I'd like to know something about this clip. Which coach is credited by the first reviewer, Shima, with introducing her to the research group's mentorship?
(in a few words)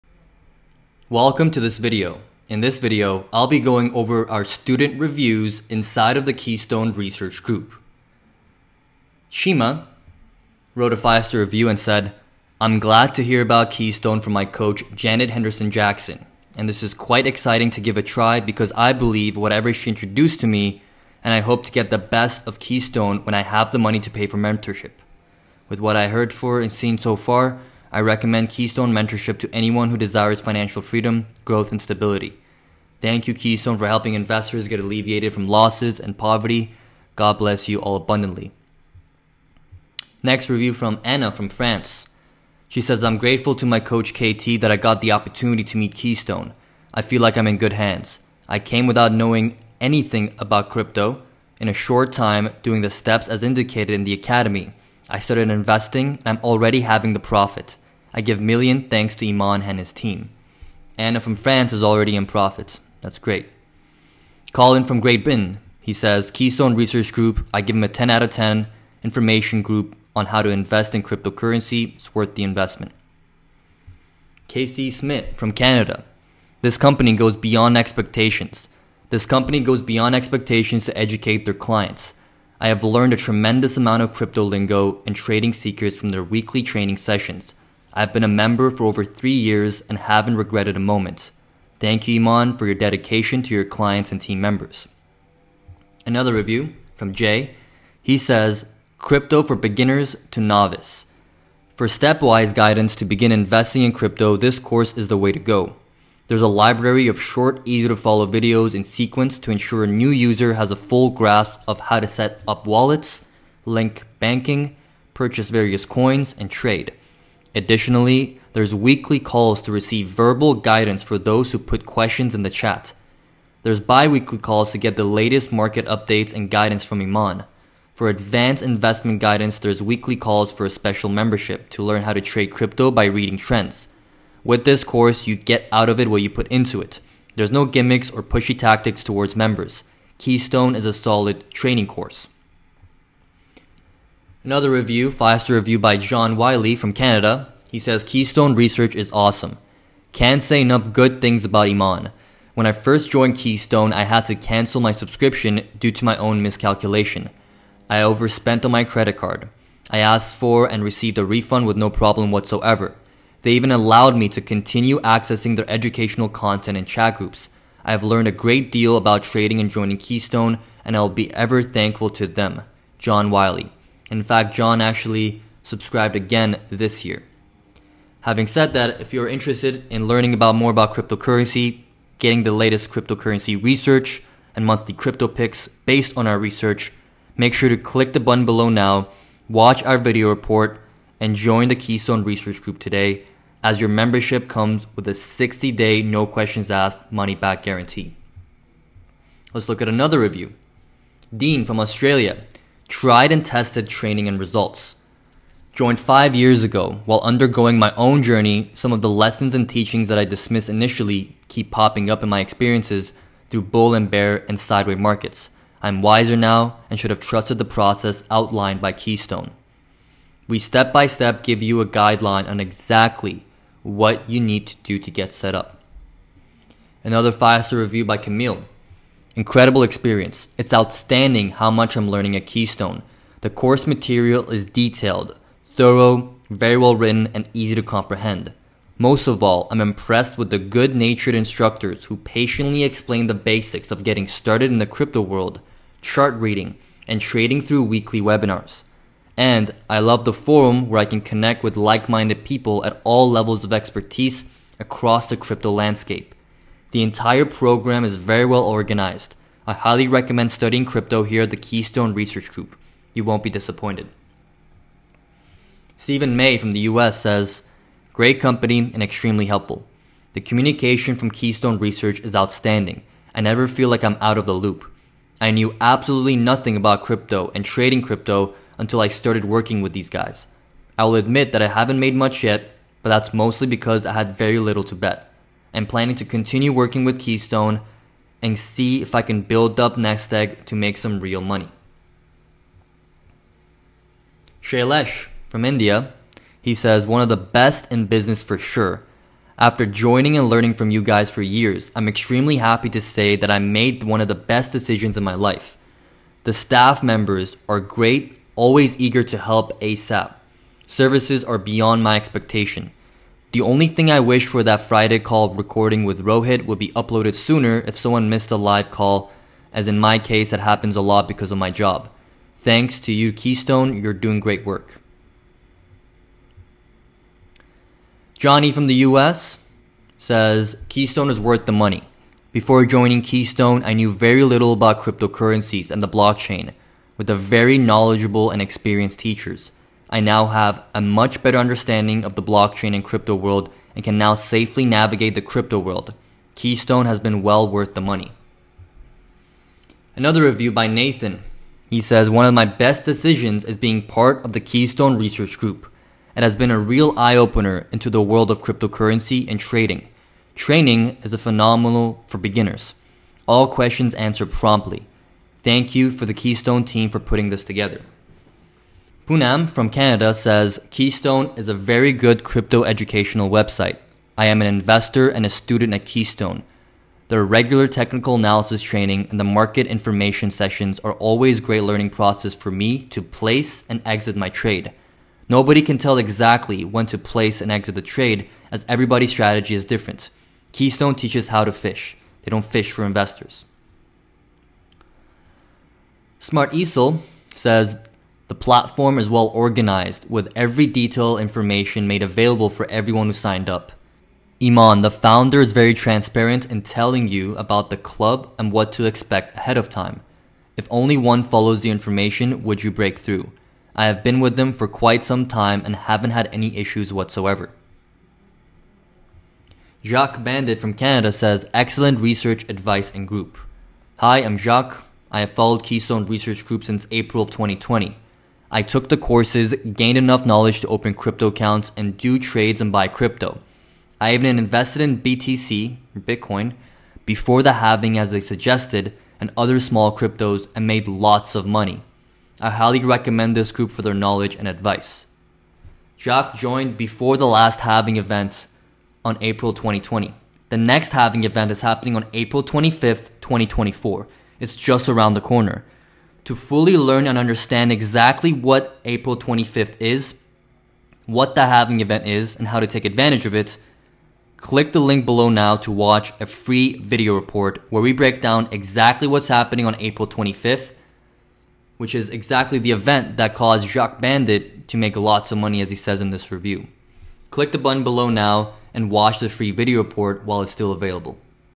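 Janet Henderson Jackson.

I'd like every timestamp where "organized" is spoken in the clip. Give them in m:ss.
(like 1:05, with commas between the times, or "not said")
4:18, 6:39.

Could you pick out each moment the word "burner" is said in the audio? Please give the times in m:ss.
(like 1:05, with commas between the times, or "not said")
not said.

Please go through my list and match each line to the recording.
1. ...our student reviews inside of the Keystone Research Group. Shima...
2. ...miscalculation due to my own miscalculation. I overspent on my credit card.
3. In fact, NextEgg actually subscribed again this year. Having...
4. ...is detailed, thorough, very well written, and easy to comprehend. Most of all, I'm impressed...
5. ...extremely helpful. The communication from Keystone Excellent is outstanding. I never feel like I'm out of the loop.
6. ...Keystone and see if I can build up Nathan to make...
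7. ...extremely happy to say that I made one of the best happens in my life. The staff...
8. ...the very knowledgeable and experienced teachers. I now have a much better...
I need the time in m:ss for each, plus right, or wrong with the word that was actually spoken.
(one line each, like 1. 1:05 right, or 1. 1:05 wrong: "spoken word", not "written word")
1. 0:04 right
2. 2:34 wrong: "subscription", not "miscalculation"
3. 2:54 wrong: "John", not "NextEgg"
4. 3:54 right
5. 4:29 wrong: "Research", not "Excellent"
6. 4:47 wrong: "NextEgg", not "Nathan"
7. 5:02 wrong: "decisions", not "happens"
8. 5:37 right.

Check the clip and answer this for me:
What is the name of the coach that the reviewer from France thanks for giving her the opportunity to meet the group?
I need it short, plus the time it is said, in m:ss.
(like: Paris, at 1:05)
KT, at 0:44.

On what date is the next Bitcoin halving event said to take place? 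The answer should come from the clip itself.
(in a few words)
April 25th, 2024.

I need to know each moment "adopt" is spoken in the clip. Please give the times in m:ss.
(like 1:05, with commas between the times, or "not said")
not said.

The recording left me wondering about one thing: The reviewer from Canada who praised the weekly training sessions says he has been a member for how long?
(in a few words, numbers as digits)
over three years.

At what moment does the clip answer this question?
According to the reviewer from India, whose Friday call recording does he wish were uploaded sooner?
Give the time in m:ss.
5:16.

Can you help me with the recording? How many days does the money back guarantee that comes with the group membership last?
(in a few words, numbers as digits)
60.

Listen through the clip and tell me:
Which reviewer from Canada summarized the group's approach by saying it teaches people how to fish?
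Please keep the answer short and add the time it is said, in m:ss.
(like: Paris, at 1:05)
Poonam, at 6:09.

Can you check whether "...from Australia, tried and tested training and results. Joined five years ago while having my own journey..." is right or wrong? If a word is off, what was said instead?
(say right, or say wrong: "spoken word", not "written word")
wrong: "undergoing", not "having".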